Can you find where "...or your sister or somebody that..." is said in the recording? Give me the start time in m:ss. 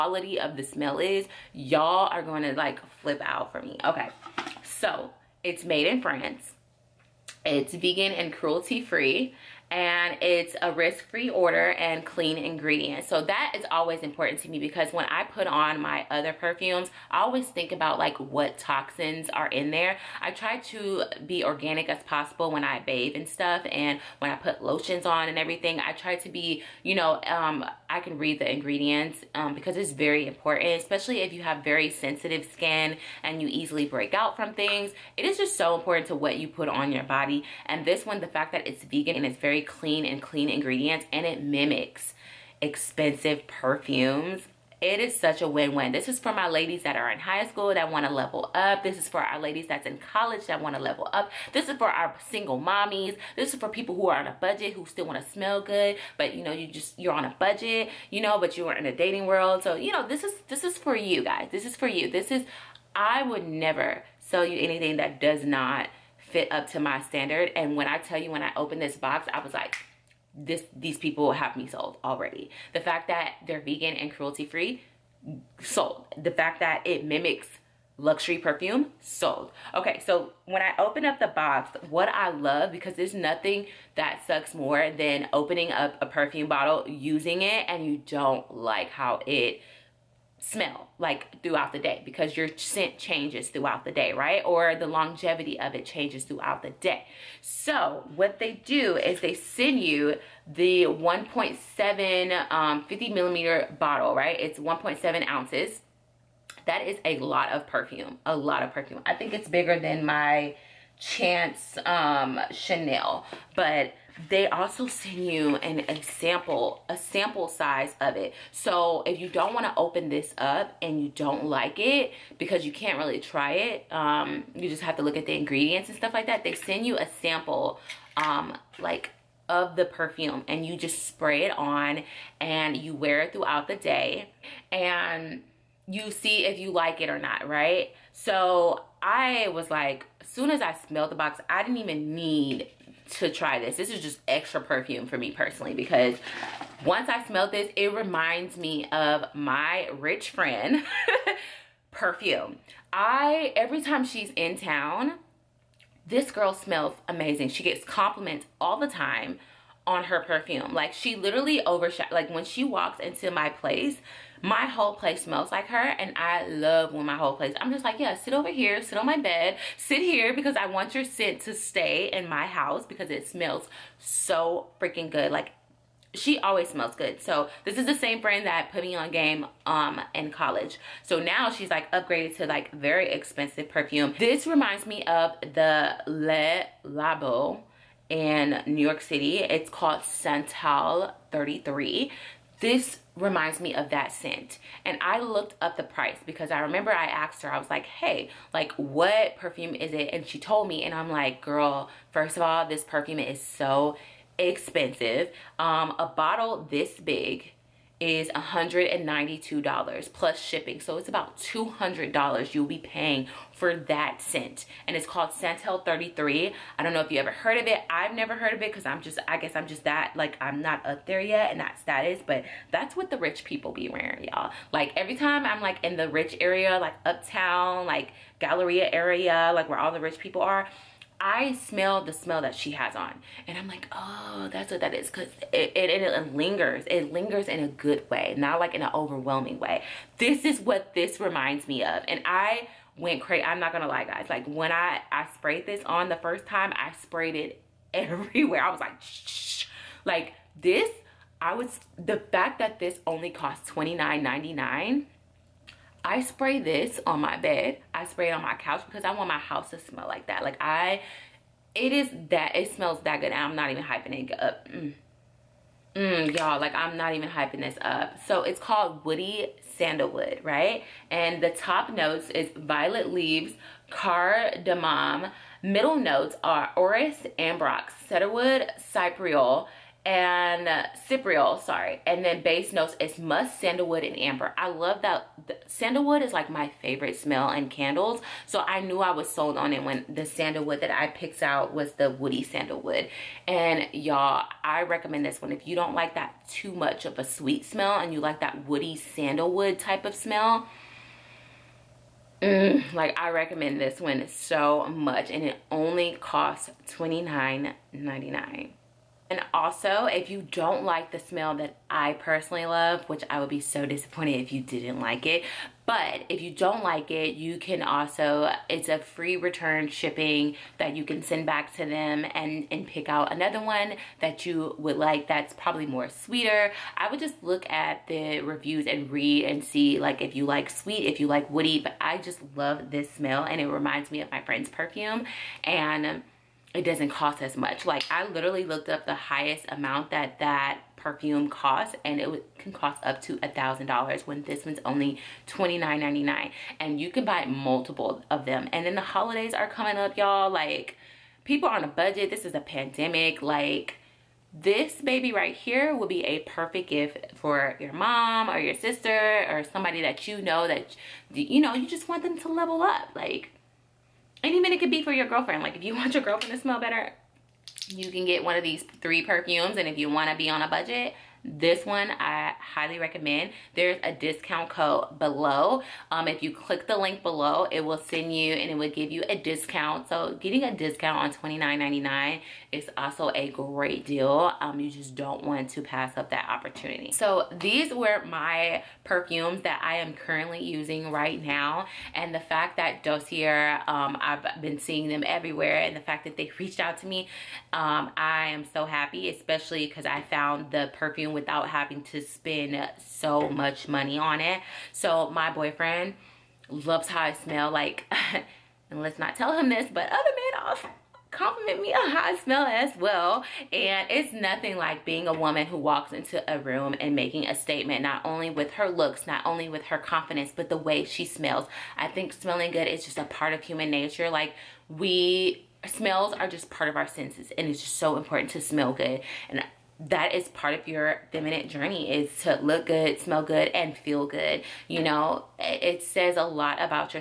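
5:58.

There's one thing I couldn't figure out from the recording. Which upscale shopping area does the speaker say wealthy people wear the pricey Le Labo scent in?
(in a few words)
Galleria.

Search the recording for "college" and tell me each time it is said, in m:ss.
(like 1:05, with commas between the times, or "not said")
0:49, 3:00.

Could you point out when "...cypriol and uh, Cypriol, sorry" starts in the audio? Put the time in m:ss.
4:38.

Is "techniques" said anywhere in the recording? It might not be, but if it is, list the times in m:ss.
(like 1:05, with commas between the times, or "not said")
not said.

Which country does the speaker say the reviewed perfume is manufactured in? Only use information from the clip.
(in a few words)
France.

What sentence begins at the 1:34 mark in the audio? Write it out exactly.
Or the longevity of it changes throughout the day.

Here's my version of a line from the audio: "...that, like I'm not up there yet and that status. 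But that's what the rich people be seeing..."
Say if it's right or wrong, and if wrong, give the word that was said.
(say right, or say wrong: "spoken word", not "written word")
wrong: "wearing", not "seeing".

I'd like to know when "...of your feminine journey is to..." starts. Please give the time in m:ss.
7:10.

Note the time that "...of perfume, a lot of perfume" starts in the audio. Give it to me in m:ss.
1:47.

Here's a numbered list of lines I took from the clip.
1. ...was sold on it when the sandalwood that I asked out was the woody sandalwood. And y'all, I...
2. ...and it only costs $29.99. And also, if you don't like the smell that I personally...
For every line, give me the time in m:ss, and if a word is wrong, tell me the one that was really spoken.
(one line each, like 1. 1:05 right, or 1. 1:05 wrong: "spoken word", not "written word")
1. 4:49 wrong: "picked", not "asked"
2. 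5:05 right.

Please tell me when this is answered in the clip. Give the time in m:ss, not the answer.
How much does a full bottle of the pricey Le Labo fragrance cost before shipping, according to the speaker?
3:28.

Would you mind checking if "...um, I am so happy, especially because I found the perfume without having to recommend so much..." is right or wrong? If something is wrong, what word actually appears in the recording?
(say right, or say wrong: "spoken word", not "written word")
wrong: "spend", not "recommend".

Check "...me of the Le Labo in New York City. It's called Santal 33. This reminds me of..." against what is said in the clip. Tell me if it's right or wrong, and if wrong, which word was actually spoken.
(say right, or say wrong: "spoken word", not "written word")
right.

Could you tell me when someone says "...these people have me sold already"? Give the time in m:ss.
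1:10.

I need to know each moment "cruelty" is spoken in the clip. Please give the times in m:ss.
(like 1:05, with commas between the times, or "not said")
0:08, 1:14.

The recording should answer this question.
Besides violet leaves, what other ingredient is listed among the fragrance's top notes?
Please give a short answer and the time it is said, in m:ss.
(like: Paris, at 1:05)
Cardamom, at 4:33.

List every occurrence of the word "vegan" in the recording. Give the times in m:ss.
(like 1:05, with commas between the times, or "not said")
0:07, 0:38, 1:13.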